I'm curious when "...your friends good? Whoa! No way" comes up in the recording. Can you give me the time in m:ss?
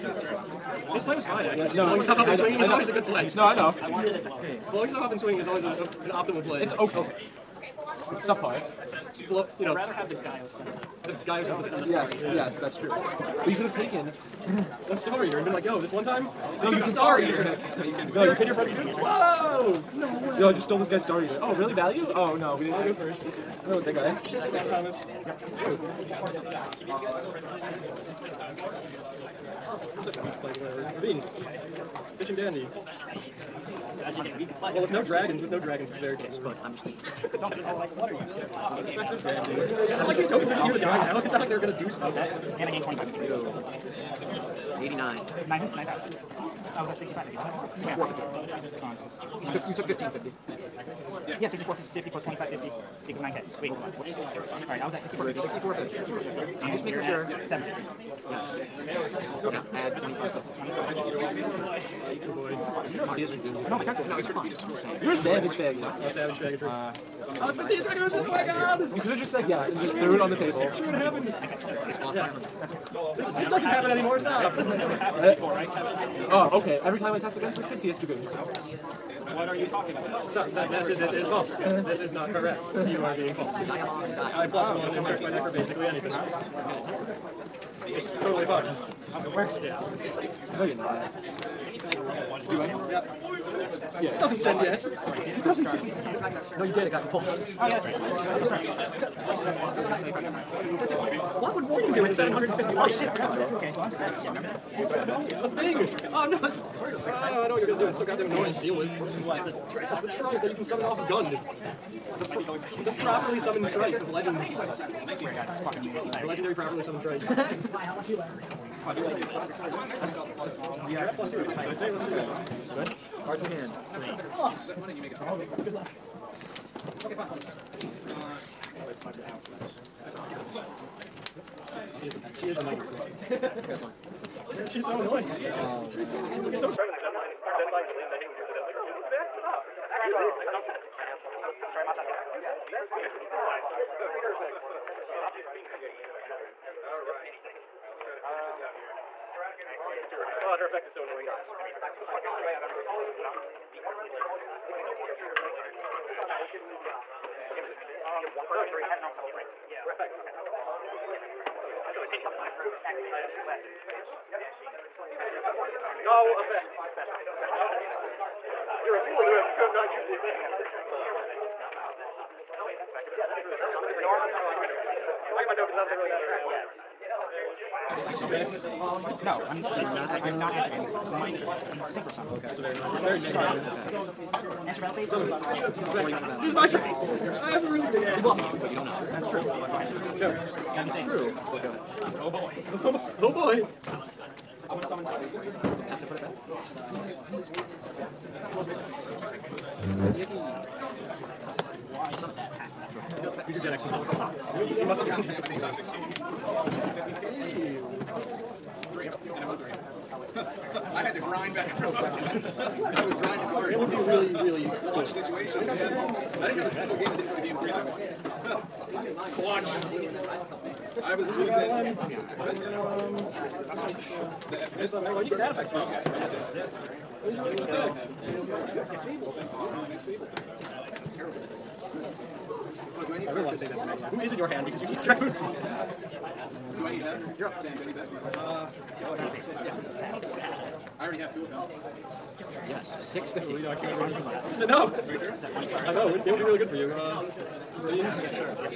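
0:18.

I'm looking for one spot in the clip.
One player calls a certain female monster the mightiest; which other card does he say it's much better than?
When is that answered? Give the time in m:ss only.
2:16.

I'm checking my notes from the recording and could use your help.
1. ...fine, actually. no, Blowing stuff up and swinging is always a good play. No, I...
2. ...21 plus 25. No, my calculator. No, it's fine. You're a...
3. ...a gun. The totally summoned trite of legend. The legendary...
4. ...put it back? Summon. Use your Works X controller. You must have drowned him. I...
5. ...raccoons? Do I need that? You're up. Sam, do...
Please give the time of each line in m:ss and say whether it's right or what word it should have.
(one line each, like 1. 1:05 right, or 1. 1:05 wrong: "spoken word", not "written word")
1. 0:01 right
2. 0:59 wrong: "25", not "21"
3. 1:50 wrong: "properly", not "totally"
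4. 3:16 wrong: "Gen", not "Works"
5. 3:55 right.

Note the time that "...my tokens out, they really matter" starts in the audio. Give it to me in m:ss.
2:55.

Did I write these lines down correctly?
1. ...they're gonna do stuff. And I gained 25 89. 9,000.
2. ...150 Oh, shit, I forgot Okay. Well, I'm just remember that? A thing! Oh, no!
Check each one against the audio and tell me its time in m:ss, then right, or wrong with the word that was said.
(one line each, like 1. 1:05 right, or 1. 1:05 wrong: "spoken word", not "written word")
1. 0:41 right
2. 1:42 wrong: "750", not "150".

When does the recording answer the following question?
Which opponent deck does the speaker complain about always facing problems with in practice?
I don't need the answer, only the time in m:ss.
1:17.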